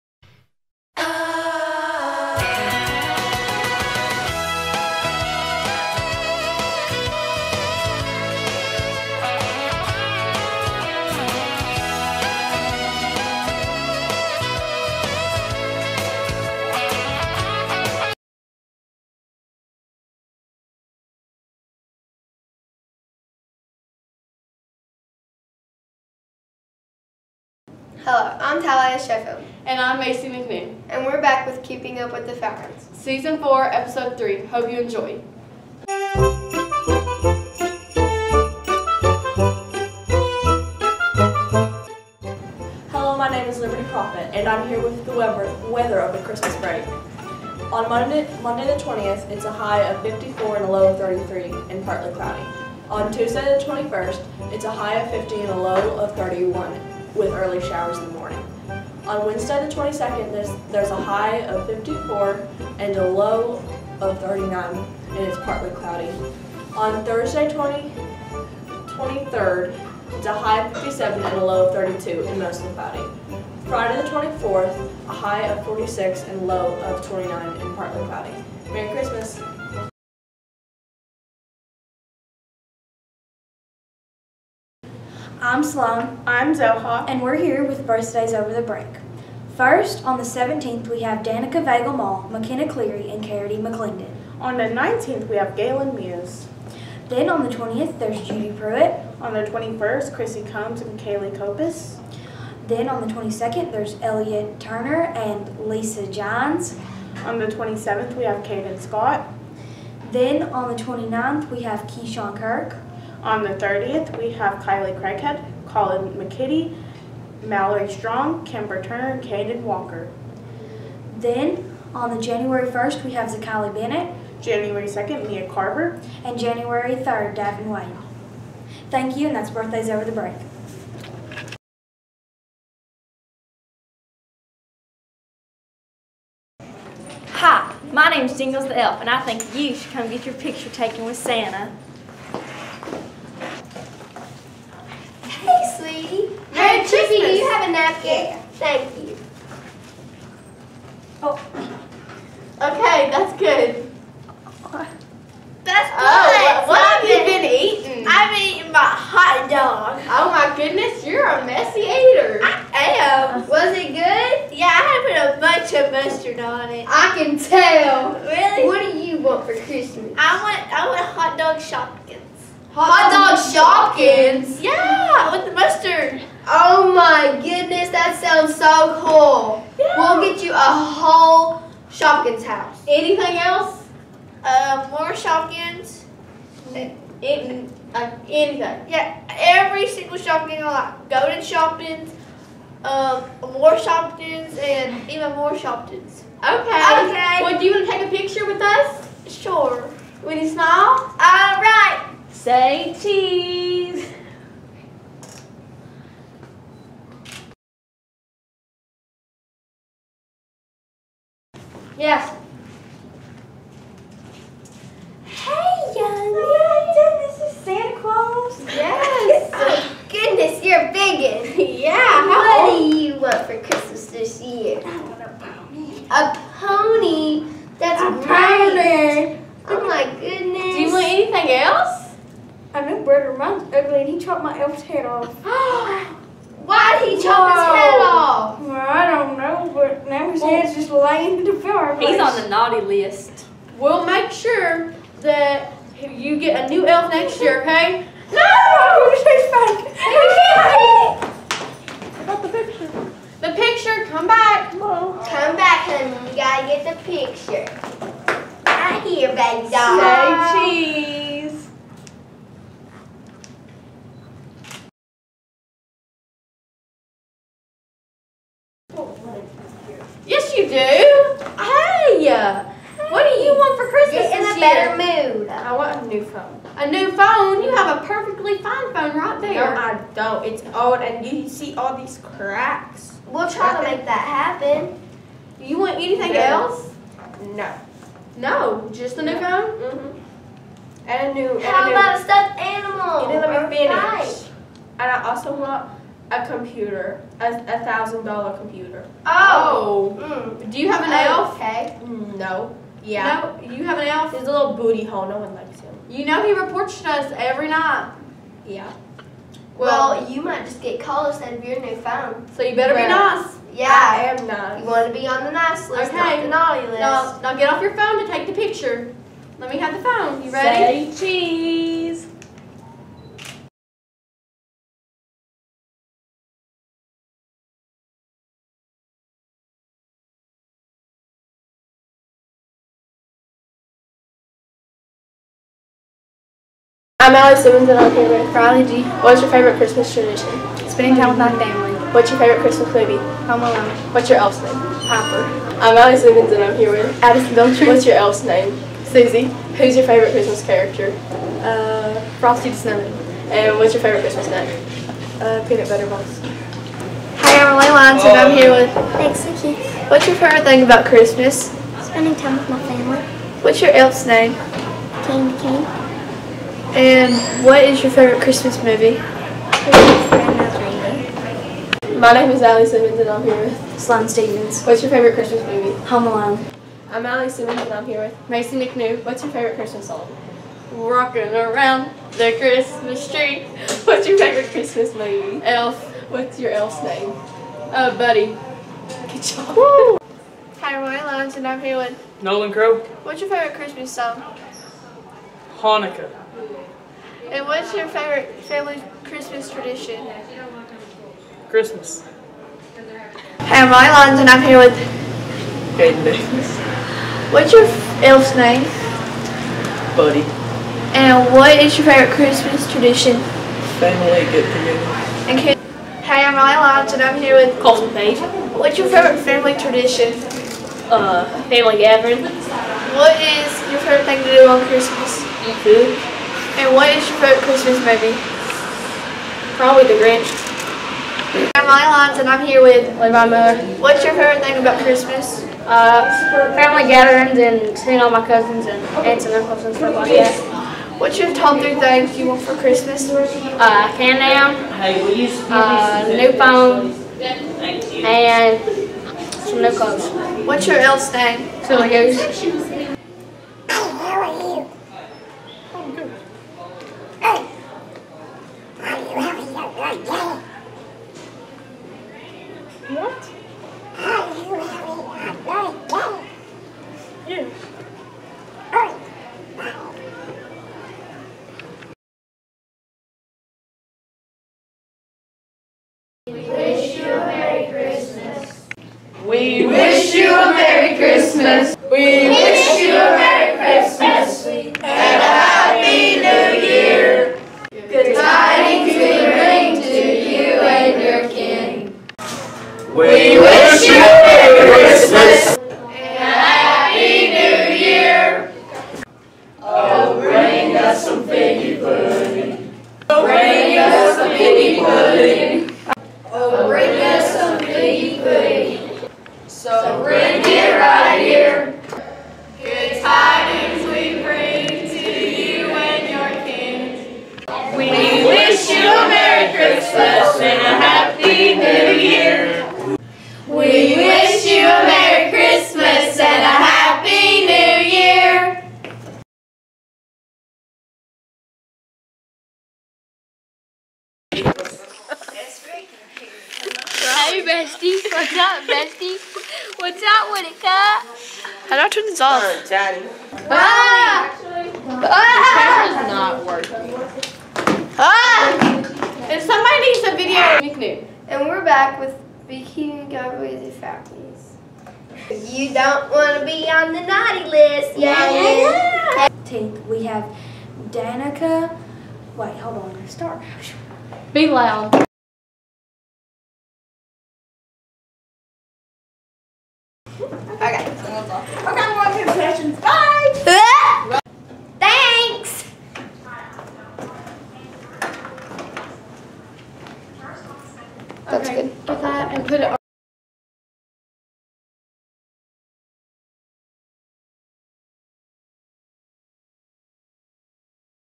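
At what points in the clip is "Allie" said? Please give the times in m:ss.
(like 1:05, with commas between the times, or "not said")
6:12, 6:17.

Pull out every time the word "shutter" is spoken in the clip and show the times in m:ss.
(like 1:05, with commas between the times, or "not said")
not said.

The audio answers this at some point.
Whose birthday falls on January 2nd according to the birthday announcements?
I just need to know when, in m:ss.
2:05.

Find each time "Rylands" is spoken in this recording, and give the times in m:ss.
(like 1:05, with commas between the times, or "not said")
6:43, 6:56.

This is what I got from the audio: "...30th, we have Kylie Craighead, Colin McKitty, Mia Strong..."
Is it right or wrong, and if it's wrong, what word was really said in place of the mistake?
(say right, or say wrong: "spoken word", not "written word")
wrong: "Mallory", not "Mia".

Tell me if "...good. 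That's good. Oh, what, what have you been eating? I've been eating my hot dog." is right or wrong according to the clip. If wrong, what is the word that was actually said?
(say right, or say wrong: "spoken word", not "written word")
right.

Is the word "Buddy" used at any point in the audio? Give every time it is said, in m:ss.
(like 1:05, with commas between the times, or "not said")
6:28, 6:50.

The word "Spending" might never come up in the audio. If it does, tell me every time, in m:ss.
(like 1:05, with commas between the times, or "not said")
5:40, 6:02.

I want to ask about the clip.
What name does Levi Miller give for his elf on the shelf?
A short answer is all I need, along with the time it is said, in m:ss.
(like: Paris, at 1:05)
Silly Goose, at 7:31.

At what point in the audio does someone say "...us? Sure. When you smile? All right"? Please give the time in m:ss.
3:18.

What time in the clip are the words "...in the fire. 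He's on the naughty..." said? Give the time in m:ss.
4:01.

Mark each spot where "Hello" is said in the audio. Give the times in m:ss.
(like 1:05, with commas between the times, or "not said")
0:28, 0:42.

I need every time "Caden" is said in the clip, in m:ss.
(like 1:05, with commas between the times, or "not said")
1:48, 1:59.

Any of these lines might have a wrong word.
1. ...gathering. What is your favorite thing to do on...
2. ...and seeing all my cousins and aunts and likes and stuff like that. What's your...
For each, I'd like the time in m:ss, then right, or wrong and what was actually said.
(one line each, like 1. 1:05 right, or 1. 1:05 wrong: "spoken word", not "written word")
1. 7:01 right
2. 7:17 wrong: "uncles", not "likes".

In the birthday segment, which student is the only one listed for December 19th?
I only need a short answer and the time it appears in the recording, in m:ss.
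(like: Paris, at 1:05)
Galen Muse, at 1:35.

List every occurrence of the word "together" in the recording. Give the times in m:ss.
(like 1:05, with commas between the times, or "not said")
6:54.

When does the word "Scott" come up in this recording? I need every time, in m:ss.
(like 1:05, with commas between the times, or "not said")
1:48.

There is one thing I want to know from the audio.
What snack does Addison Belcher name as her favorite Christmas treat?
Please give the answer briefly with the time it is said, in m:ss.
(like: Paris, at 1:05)
Peanut butter balls, at 5:55.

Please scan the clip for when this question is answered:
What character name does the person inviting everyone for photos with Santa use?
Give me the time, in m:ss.
2:18.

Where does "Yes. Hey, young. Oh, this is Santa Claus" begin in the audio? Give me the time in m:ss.
3:32.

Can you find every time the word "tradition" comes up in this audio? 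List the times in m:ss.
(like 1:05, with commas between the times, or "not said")
5:40, 6:39, 6:52, 6:59.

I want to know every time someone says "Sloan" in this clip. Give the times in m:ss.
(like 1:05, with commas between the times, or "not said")
1:25, 6:13.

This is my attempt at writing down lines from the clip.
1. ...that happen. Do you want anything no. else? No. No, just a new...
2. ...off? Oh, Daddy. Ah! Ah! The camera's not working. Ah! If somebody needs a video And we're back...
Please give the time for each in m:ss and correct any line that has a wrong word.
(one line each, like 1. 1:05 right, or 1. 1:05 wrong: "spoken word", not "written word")
1. 4:44 right
2. 9:02 right.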